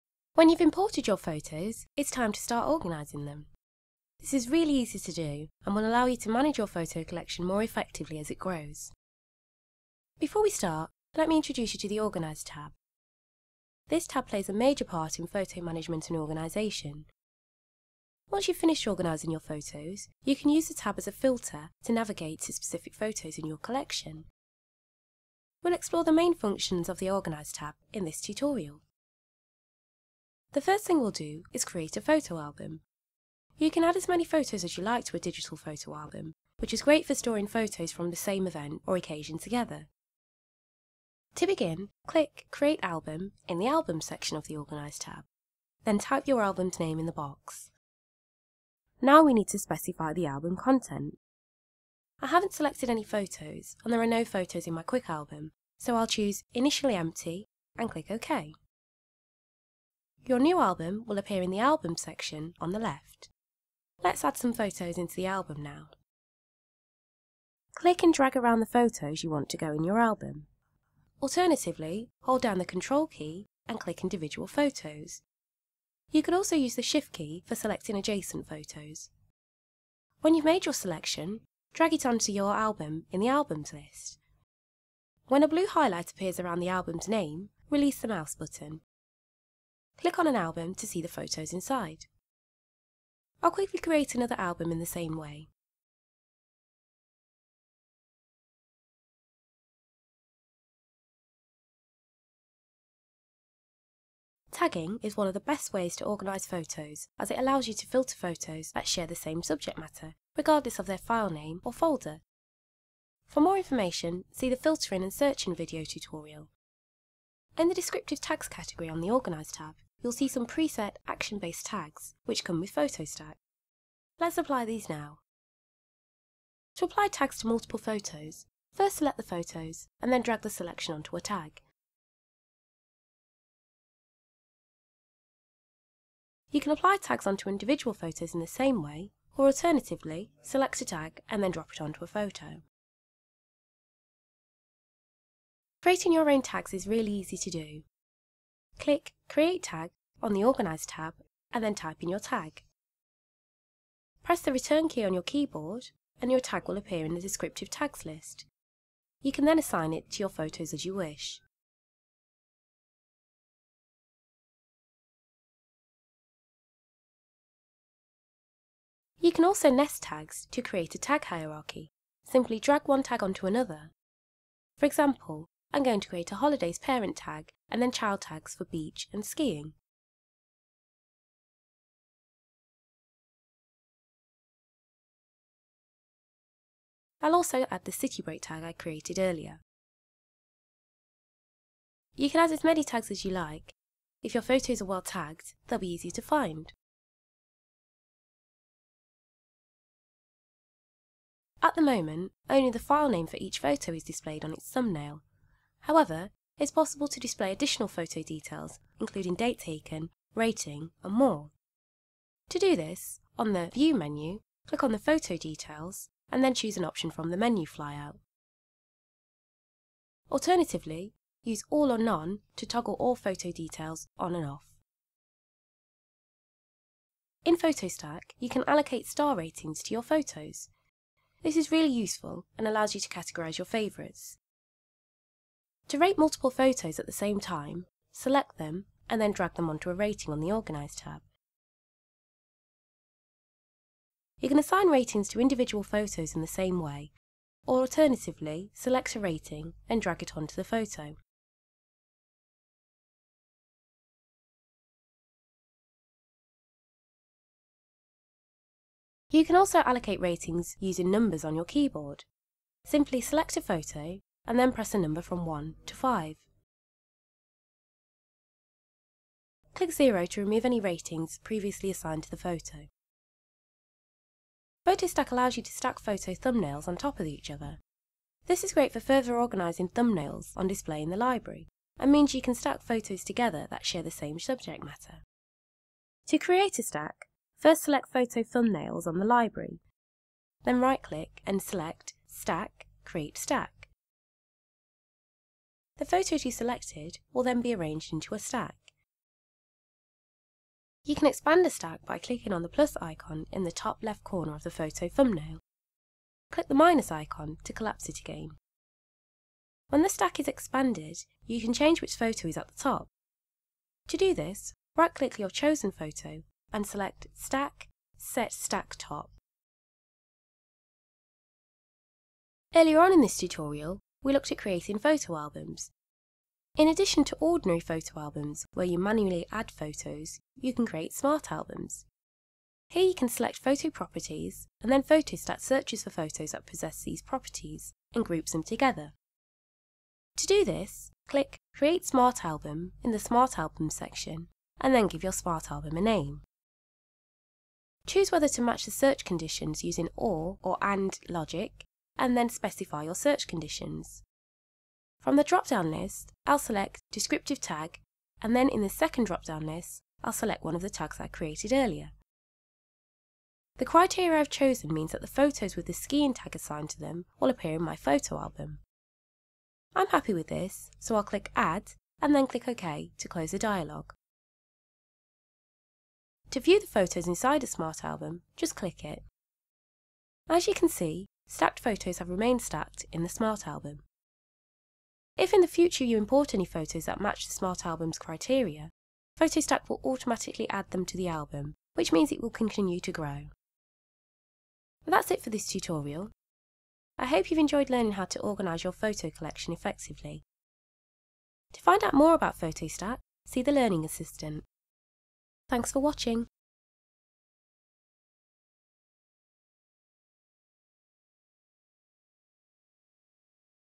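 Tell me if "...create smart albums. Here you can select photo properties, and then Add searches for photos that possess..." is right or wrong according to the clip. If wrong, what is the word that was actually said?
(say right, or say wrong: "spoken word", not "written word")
wrong: "PhotoStack", not "Add".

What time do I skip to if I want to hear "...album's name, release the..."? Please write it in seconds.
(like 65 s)
86 s.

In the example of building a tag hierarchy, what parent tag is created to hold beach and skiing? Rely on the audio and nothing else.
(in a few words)
Holidays.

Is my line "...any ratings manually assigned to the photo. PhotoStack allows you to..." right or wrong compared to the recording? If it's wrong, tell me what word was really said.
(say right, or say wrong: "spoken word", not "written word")
wrong: "previously", not "manually".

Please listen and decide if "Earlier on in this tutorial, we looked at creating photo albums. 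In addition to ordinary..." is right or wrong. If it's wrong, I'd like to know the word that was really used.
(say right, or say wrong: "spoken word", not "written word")
right.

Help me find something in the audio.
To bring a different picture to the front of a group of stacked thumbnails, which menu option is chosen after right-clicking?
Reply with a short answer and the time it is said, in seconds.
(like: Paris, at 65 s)
Set Stack Top, at 318 s.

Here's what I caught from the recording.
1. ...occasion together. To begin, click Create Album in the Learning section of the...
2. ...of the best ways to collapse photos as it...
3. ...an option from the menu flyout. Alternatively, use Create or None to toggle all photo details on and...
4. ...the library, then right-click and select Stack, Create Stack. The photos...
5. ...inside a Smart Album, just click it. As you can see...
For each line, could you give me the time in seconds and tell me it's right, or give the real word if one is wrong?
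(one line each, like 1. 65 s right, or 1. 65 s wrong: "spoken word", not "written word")
1. 38 s wrong: "Album", not "Learning"
2. 105 s wrong: "organise", not "collapse"
3. 216 s wrong: "All", not "Create"
4. 289 s right
5. 377 s right.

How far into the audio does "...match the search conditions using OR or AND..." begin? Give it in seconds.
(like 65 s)
348 s.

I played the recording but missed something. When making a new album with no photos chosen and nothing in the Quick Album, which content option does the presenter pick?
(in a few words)
Initially Empty.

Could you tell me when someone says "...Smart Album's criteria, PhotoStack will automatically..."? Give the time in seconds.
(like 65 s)
387 s.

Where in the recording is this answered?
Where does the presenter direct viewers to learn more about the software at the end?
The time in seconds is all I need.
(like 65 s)
403 s.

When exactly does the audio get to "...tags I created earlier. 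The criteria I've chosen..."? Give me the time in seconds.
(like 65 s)
360 s.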